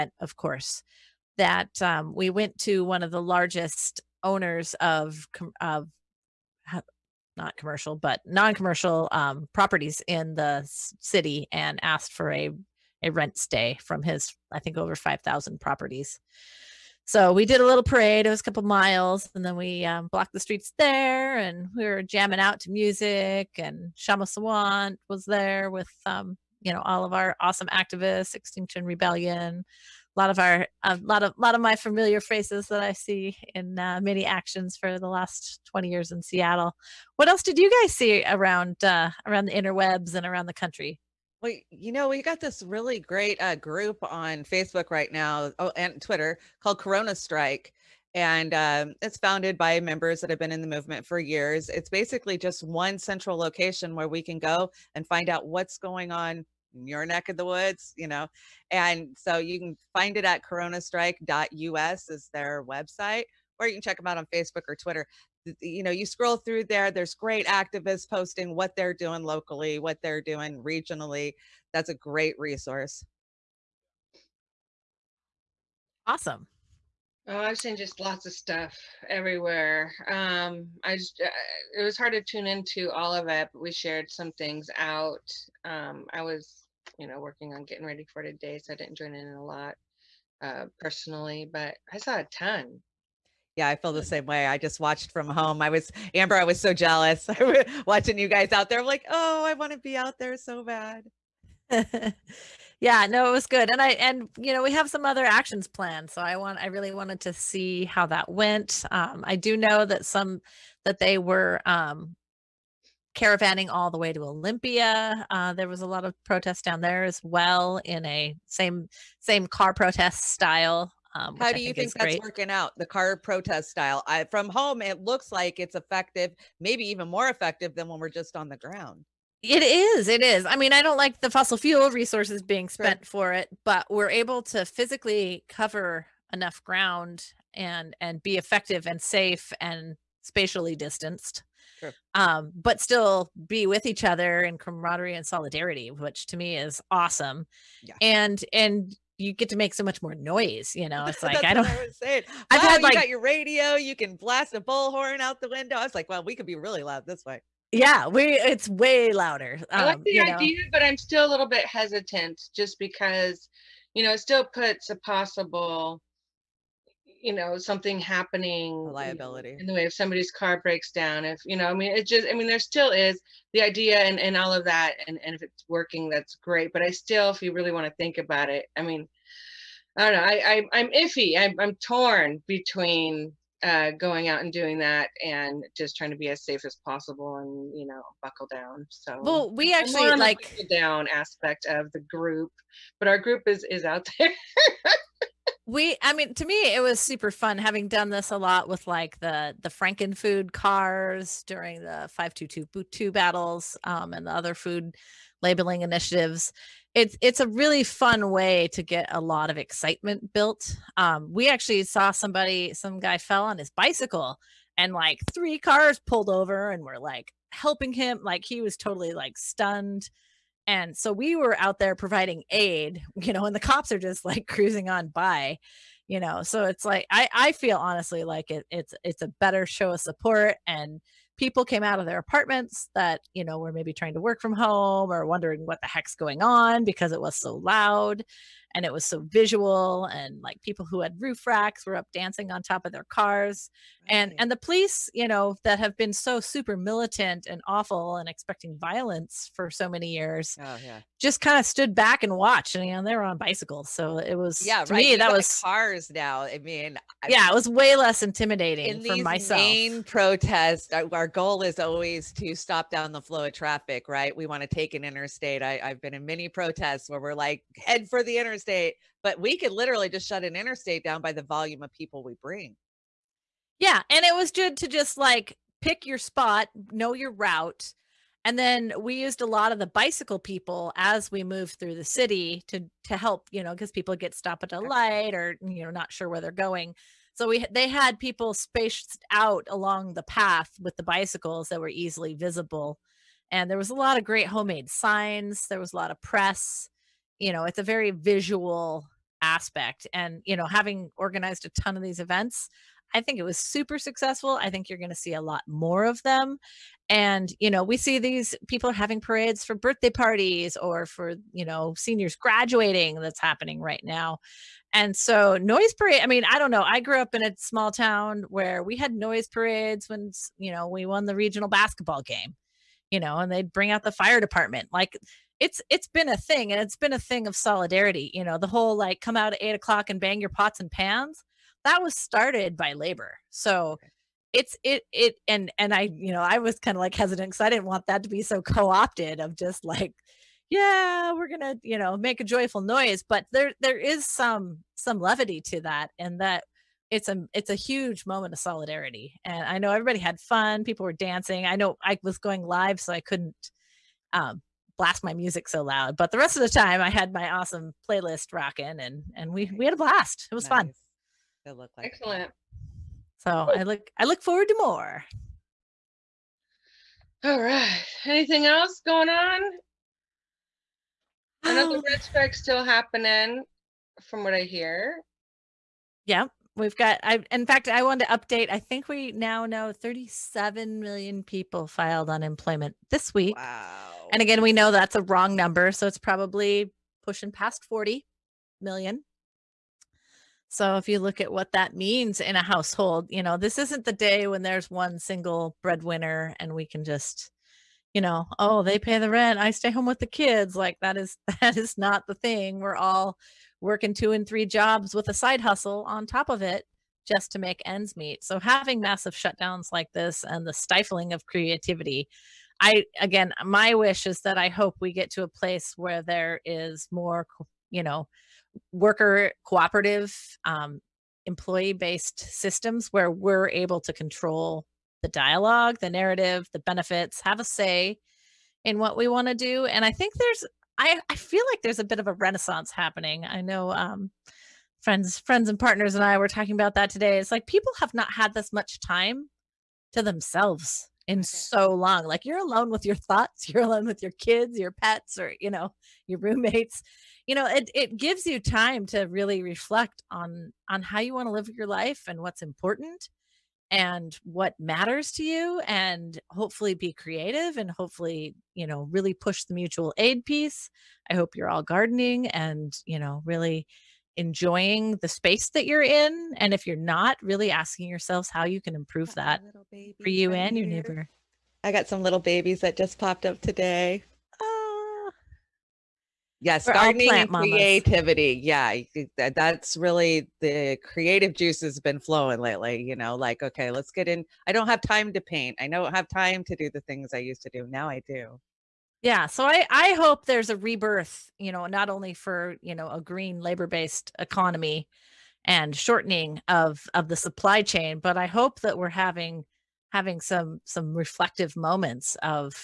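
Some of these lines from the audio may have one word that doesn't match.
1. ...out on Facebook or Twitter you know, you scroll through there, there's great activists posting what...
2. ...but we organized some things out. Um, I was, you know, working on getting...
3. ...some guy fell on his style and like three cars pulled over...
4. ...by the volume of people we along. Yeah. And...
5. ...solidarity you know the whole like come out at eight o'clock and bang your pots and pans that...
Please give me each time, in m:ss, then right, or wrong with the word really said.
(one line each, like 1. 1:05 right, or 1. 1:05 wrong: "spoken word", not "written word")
1. 1:04 right
2. 1:23 wrong: "shared", not "organized"
3. 3:32 wrong: "bicycle", not "style"
4. 4:31 wrong: "bring", not "along"
5. 5:27 right.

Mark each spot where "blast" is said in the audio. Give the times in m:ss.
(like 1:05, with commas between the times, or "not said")
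2:34, 5:54, 5:59.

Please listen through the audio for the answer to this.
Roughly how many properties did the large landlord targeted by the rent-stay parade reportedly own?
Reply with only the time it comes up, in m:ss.
0:14.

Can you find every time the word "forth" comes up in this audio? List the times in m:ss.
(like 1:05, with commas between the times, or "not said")
not said.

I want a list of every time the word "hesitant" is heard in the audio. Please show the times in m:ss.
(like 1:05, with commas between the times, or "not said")
2:41, 5:37.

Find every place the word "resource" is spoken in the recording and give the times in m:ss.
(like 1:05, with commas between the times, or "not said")
1:12, 2:11.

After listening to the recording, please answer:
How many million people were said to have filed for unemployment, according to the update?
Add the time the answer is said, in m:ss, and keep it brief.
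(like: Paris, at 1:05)
37 million, at 6:19.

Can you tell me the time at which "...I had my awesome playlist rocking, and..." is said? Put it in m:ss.
5:57.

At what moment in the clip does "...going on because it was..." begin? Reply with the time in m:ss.
3:56.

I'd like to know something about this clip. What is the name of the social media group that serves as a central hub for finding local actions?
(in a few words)
Corona Strike.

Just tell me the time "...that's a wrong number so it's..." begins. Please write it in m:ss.
6:24.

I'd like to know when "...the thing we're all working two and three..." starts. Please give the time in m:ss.
6:42.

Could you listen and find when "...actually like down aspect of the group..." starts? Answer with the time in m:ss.
3:09.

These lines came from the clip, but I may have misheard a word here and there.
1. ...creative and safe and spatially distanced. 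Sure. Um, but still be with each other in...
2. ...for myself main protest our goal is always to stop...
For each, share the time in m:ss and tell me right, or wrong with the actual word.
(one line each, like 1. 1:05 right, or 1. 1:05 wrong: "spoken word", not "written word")
1. 2:18 wrong: "effective", not "creative"
2. 4:19 right.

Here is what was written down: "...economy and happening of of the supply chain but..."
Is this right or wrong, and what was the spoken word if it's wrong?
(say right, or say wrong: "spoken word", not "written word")
wrong: "shortening", not "happening".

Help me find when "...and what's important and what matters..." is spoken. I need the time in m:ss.
7:32.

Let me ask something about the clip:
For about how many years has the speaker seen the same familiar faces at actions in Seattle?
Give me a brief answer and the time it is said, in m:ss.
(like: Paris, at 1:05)
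20 years, at 0:35.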